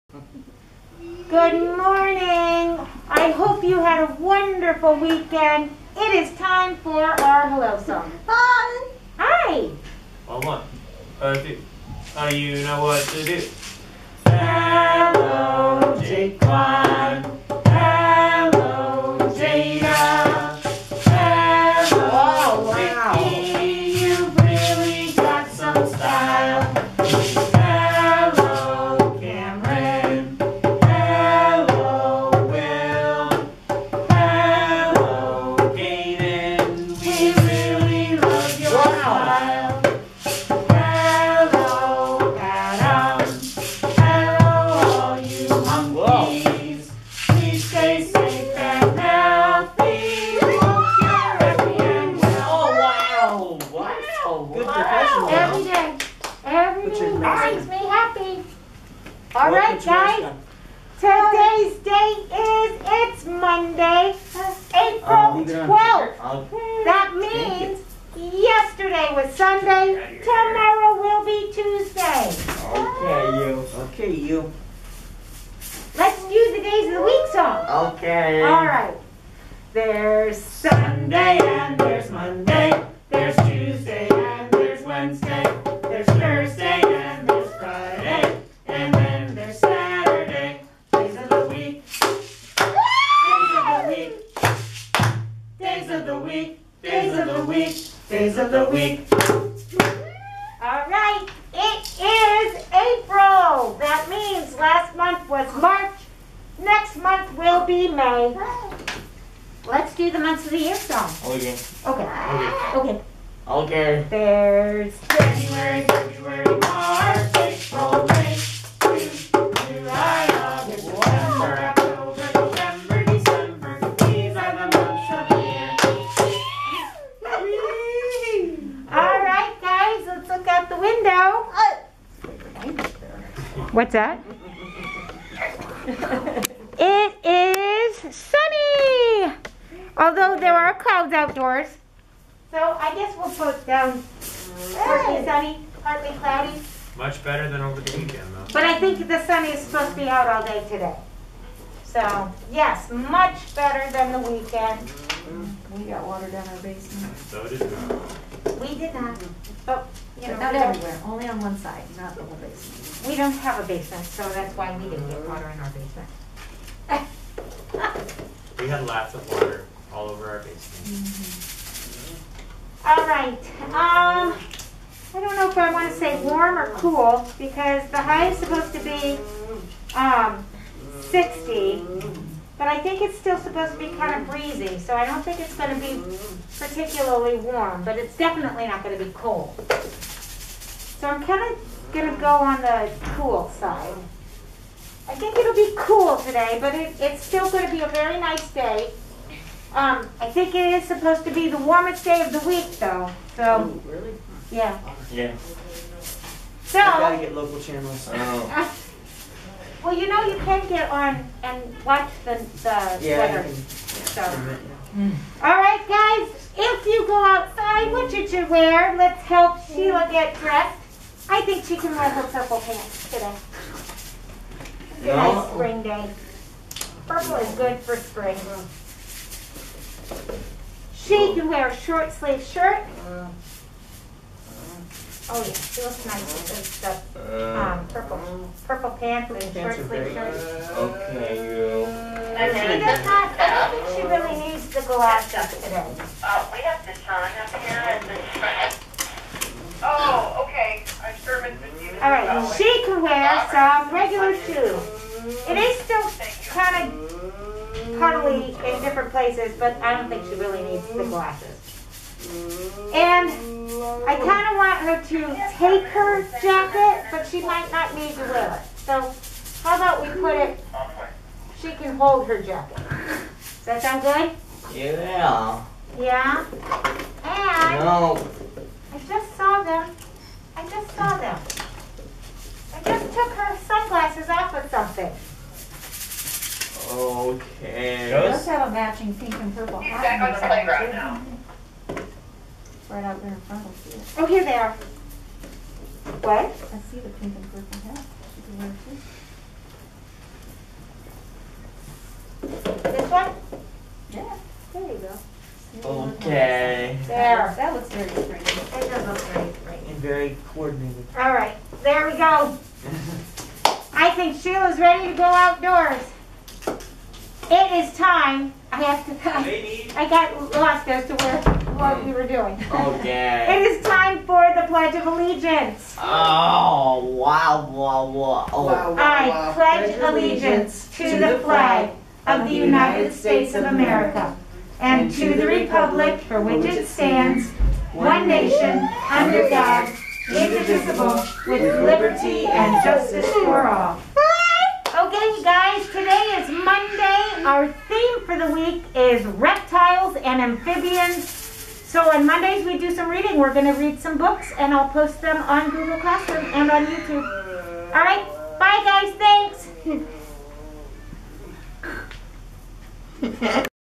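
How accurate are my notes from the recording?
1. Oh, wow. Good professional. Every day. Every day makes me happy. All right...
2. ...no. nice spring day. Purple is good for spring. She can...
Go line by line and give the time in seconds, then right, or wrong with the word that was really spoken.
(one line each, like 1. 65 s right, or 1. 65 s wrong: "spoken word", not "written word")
1. 53 s right
2. 225 s right.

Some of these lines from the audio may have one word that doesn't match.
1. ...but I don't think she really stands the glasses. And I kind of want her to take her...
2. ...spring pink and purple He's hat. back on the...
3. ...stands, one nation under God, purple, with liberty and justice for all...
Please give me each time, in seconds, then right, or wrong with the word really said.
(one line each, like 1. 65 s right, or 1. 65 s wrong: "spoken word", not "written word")
1. 259 s wrong: "needs", not "stands"
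2. 288 s wrong: "matching", not "spring"
3. 336 s wrong: "indivisible", not "purple".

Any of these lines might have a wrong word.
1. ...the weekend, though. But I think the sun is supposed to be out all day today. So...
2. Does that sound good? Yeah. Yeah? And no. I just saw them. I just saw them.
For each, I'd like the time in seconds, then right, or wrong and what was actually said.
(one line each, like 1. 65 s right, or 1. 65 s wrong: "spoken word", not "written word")
1. 147 s right
2. 272 s right.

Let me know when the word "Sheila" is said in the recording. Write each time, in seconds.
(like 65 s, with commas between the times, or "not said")
219 s, 314 s.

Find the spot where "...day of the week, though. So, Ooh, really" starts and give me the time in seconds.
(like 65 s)
202 s.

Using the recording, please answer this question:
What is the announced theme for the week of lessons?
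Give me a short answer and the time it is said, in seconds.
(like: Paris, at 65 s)
Reptiles and amphibians, at 349 s.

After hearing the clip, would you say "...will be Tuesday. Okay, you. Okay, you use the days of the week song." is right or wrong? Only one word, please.
right.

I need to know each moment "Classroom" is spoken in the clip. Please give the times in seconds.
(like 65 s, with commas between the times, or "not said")
355 s.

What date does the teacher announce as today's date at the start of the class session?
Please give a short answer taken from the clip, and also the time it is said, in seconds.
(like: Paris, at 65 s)
Monday, April 12th, at 63 s.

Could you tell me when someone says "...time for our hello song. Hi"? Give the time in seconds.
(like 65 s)
6 s.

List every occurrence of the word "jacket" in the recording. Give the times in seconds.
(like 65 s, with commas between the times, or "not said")
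266 s, 272 s.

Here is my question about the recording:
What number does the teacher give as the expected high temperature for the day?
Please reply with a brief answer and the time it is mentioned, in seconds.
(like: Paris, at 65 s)
60, at 181 s.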